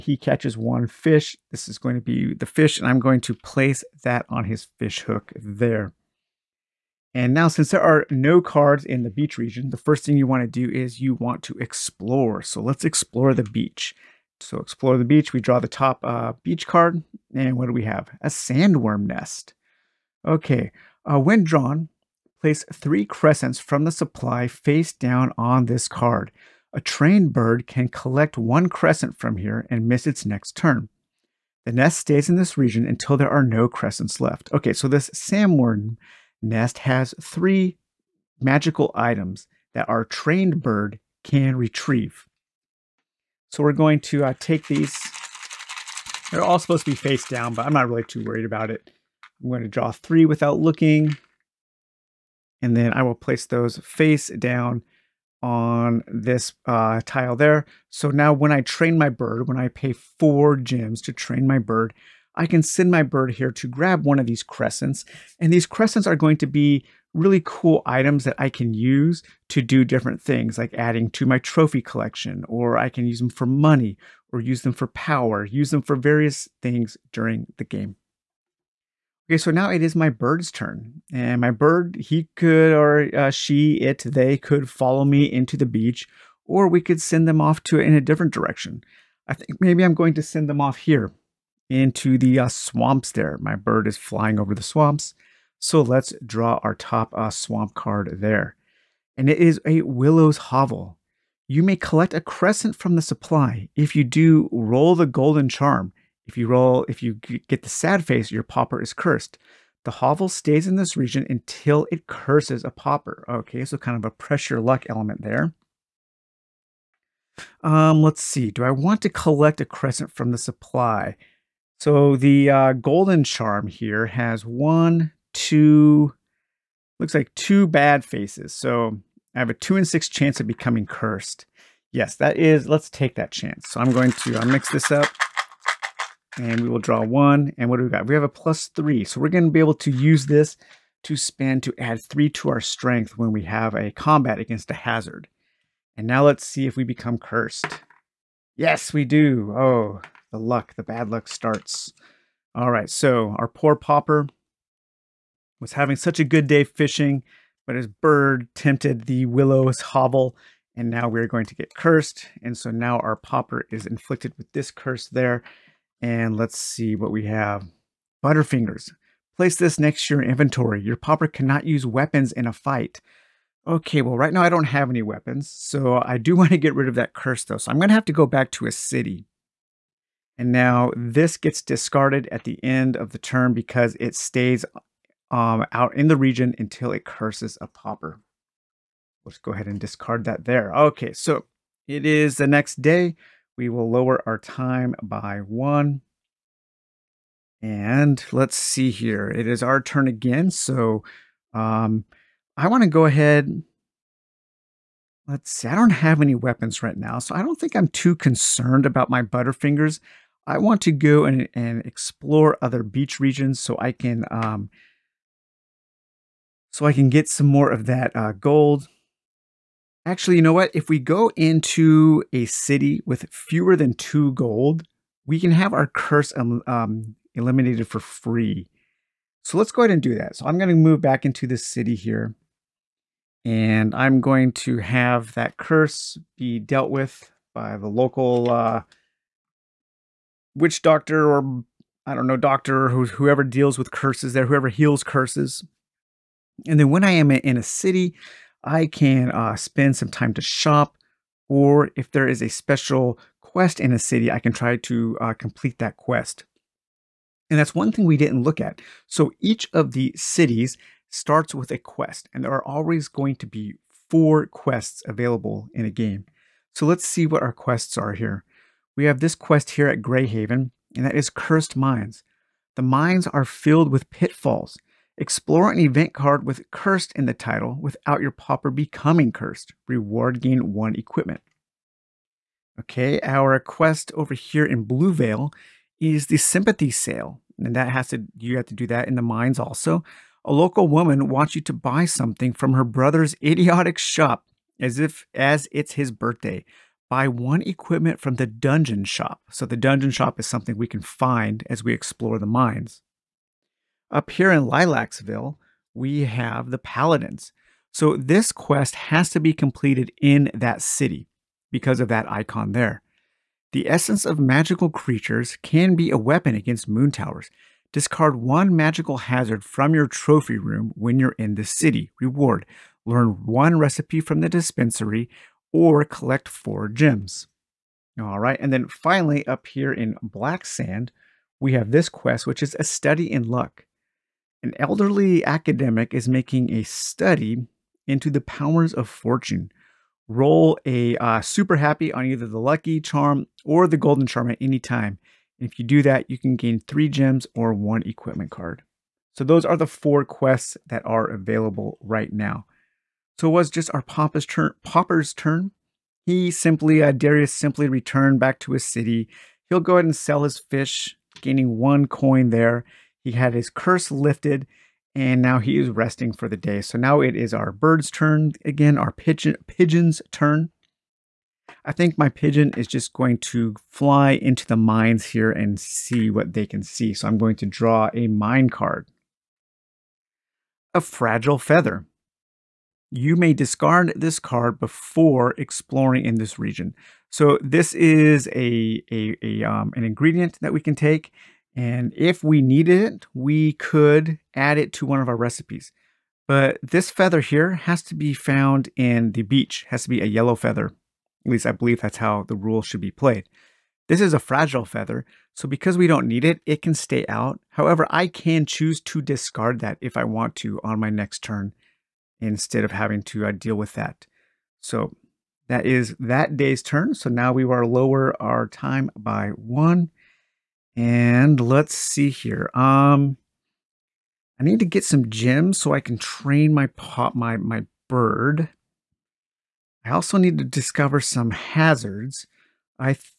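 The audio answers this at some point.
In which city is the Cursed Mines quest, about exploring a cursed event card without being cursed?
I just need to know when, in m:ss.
4:30.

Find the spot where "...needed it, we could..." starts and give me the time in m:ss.
6:32.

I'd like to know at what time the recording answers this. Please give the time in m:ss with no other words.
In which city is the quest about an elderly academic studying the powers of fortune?
5:30.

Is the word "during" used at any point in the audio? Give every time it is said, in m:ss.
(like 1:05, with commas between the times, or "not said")
1:17.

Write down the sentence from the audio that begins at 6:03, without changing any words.
He had his curse lifted, and now he is resting for the day.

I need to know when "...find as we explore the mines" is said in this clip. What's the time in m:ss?
5:01.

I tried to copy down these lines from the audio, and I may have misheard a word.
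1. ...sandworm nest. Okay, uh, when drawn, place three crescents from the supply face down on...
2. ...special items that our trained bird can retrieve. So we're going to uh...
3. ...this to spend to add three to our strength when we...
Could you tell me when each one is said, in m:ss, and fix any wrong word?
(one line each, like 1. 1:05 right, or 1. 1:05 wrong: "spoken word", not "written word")
1. 0:18 right
2. 0:38 wrong: "magical", not "special"
3. 2:20 right.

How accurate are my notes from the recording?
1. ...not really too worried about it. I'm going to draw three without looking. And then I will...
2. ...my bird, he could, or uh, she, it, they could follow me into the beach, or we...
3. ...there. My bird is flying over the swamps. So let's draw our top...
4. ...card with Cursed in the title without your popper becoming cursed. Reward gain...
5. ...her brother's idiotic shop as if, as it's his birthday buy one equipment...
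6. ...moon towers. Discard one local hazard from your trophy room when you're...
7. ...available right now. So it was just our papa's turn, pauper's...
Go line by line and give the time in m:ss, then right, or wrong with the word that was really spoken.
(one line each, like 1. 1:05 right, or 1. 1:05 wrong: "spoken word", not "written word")
1. 0:47 right
2. 1:21 right
3. 1:33 right
4. 4:36 wrong: "pauper", not "popper"
5. 4:52 right
6. 5:16 wrong: "magical", not "local"
7. 5:51 right.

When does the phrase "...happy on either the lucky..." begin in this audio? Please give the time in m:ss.
5:41.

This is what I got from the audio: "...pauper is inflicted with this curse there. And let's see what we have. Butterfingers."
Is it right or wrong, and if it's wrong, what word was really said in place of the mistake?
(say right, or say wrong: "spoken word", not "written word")
right.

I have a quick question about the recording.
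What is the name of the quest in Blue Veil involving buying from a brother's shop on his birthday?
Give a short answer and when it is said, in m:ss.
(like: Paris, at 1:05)
Sympathy Sale, at 4:46.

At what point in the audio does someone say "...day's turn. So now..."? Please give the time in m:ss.
6:56.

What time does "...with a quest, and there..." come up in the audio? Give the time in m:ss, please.
4:21.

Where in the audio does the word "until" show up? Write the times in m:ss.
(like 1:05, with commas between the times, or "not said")
0:32, 1:51, 3:06.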